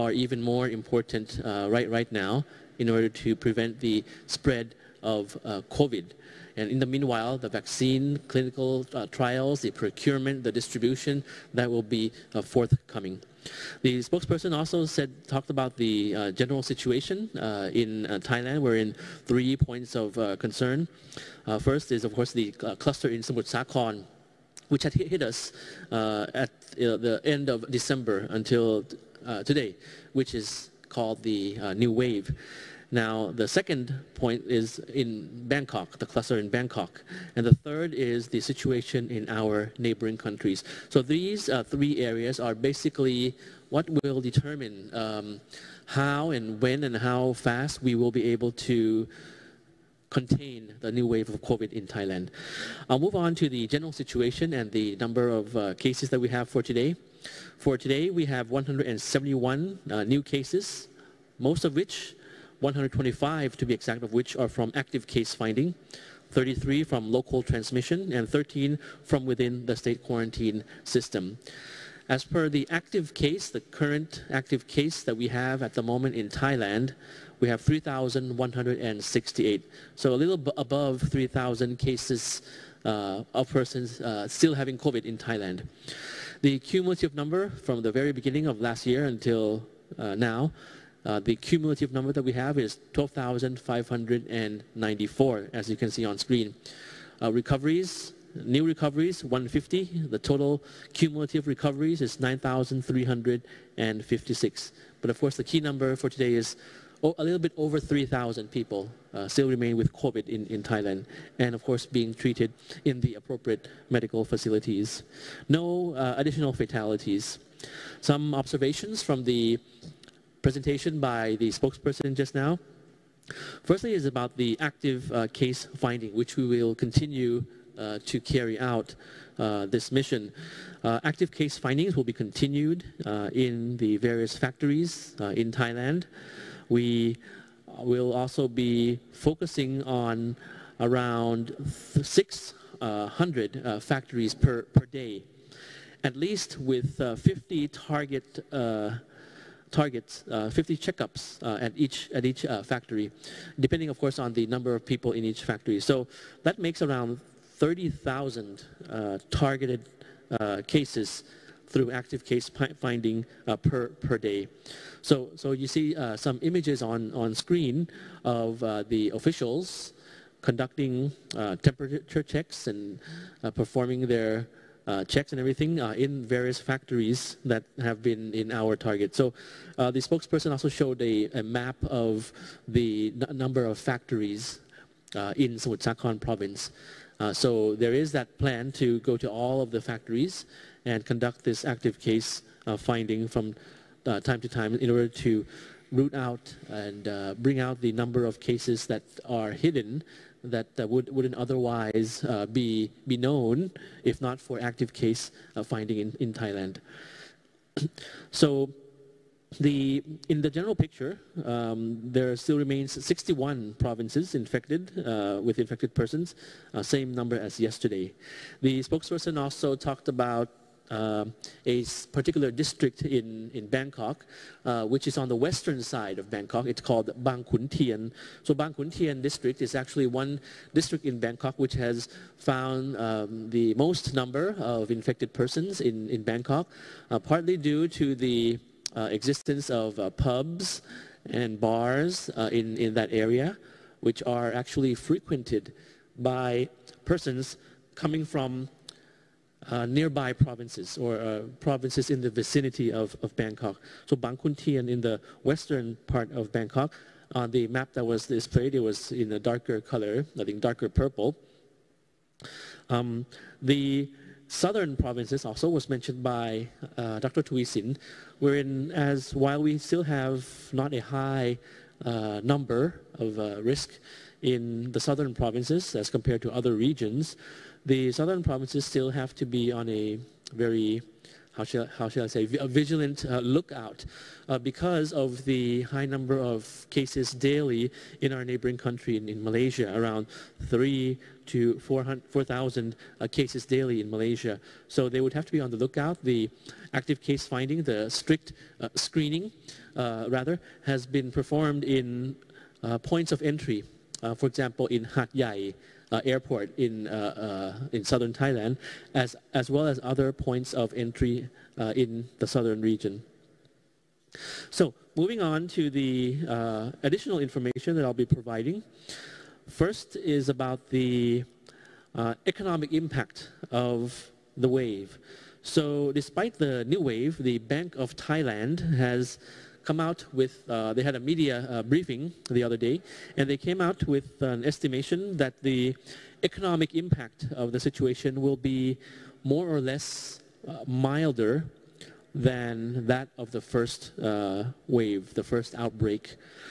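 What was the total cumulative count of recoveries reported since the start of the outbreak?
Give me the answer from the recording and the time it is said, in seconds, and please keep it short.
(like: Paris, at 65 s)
9,356, at 102 s.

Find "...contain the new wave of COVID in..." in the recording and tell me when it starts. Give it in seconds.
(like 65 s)
50 s.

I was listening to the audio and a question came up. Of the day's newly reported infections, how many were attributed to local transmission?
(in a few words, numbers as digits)
33.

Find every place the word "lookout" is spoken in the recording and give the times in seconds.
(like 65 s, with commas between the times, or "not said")
283 s, 295 s.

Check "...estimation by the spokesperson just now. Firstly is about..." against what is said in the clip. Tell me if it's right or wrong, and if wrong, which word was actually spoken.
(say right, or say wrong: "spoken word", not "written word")
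wrong: "presentation", not "estimation".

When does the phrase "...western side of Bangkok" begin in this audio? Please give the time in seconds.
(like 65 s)
225 s.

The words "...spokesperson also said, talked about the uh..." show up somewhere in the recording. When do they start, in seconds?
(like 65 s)
13 s.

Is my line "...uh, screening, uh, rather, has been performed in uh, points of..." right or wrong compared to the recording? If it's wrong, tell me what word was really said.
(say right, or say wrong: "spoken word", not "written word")
right.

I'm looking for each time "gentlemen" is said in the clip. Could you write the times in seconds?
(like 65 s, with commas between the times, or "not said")
not said.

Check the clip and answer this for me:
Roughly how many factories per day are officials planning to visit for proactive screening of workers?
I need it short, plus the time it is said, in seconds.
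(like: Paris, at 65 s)
600, at 142 s.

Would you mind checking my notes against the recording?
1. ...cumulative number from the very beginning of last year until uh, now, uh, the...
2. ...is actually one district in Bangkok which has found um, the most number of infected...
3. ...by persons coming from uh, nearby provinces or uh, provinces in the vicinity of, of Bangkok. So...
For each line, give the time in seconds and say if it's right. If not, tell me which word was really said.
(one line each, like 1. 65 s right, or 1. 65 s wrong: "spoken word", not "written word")
1. 86 s right
2. 229 s right
3. 246 s right.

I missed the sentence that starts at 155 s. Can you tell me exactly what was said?
So that makes around 30,000 uh, targeted uh, cases through active case finding uh, per, per day.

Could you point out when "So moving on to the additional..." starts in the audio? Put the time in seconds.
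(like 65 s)
314 s.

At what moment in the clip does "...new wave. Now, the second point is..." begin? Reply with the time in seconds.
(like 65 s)
31 s.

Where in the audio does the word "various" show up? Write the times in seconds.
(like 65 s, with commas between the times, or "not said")
133 s, 176 s.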